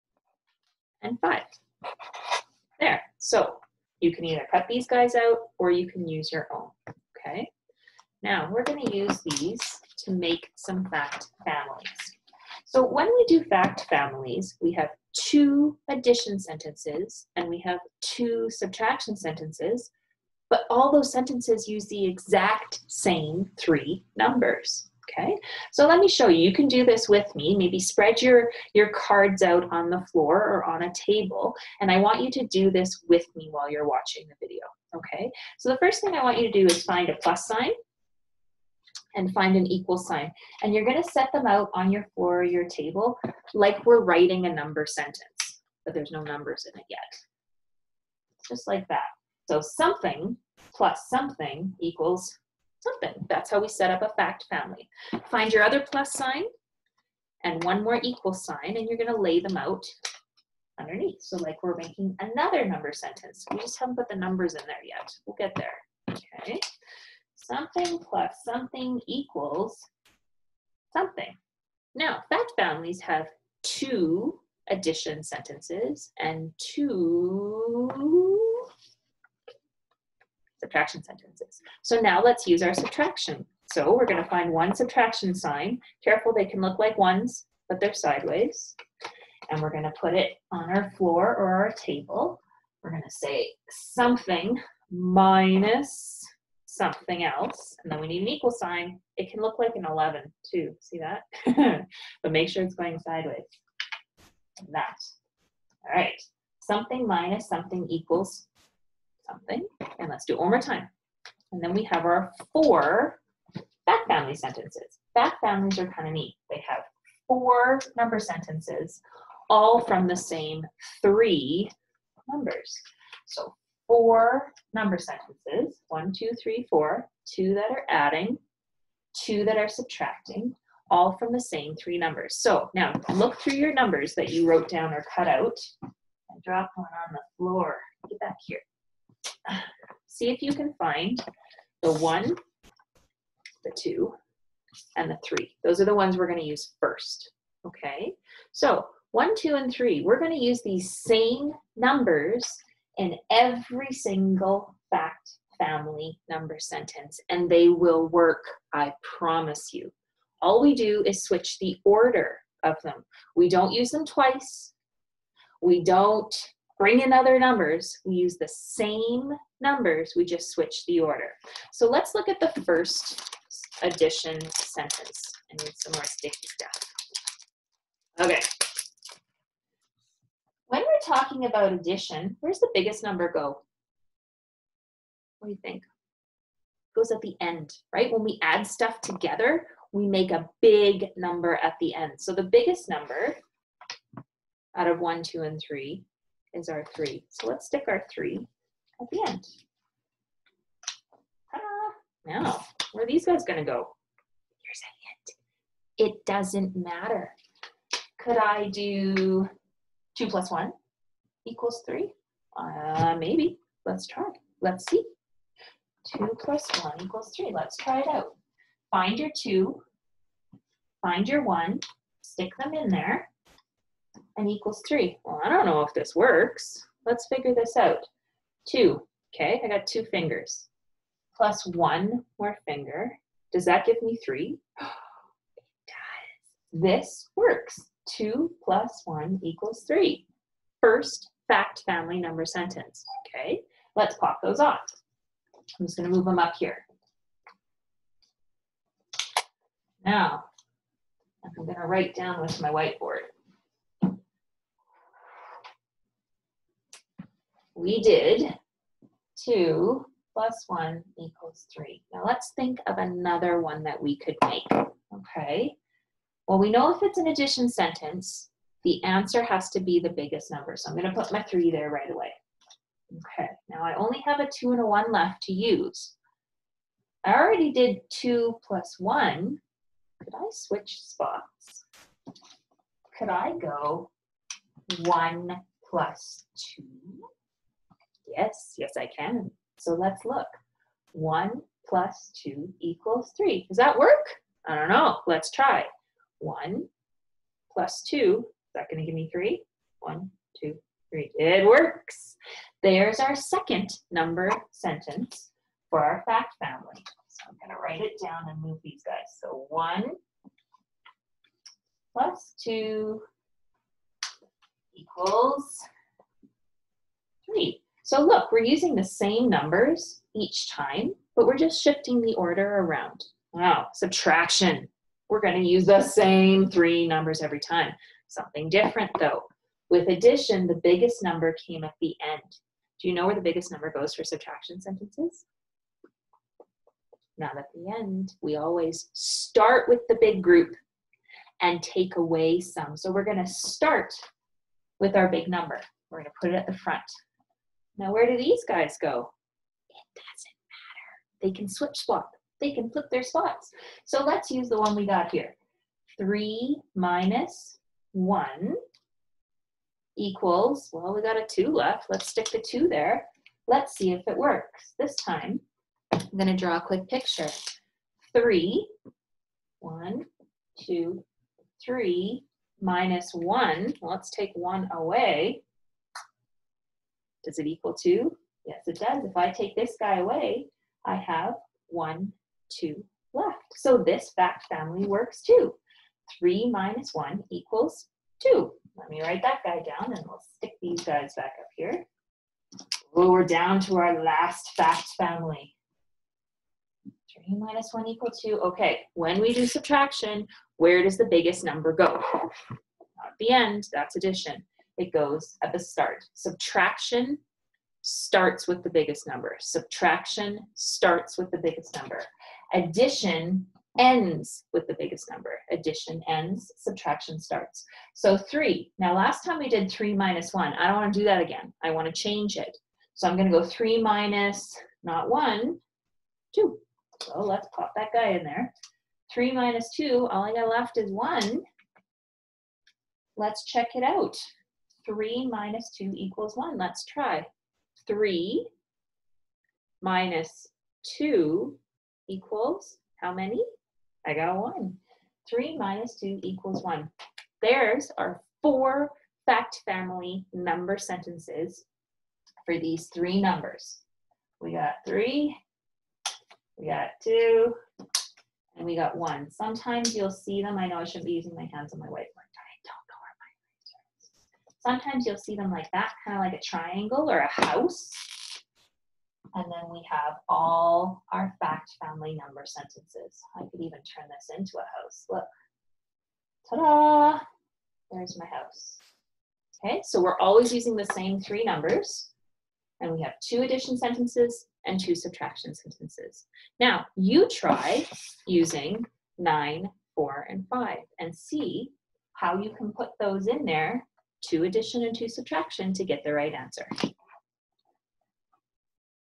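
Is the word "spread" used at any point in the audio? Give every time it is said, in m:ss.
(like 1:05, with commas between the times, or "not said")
0:27.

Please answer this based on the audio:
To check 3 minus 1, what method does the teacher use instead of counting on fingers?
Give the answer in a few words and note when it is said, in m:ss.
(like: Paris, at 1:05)
a quick picture, at 6:06.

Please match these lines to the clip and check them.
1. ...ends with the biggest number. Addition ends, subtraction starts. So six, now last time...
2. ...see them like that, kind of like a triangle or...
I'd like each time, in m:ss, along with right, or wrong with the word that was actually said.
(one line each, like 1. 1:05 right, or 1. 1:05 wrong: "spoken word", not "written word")
1. 6:53 wrong: "three", not "six"
2. 7:45 right.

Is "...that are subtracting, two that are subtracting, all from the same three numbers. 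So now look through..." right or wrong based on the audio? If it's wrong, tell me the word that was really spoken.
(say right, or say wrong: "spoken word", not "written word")
wrong: "adding", not "subtracting".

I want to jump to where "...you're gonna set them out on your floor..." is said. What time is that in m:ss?
0:40.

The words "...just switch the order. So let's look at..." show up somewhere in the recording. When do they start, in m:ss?
2:50.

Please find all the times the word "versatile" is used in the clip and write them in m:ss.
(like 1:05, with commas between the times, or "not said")
not said.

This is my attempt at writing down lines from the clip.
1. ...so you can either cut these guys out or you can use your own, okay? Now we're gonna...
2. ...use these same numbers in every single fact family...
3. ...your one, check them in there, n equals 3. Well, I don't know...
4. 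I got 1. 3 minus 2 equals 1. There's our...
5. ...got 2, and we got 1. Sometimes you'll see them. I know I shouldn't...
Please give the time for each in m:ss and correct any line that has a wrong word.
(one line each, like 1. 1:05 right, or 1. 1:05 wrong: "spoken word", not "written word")
1. 0:03 right
2. 2:30 right
3. 3:41 wrong: "stick", not "check"
4. 7:24 right
5. 7:36 right.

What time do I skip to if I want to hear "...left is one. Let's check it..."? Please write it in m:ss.
7:10.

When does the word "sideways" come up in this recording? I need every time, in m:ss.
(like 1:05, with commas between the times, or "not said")
1:27, 1:42.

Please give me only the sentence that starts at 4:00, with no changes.
First fact family number sentence, okay?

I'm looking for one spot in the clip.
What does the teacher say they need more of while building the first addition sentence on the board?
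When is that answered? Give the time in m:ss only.
2:56.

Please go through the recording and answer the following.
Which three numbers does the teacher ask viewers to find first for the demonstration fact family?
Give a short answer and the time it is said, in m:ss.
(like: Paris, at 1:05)
1, 2, and 3, at 2:21.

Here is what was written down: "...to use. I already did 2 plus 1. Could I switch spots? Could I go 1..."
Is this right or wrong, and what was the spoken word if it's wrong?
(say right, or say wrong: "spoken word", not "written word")
right.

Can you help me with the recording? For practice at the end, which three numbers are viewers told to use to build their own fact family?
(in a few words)
9, 4, and 5.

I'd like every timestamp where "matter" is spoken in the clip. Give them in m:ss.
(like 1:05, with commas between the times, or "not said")
3:26, 5:50.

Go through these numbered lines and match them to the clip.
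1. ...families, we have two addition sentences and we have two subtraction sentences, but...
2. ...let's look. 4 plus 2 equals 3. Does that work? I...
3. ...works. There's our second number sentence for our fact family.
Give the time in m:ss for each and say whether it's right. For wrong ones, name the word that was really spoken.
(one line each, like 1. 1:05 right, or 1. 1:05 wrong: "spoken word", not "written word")
1. 0:13 right
2. 4:49 wrong: "1", not "4"
3. 5:01 right.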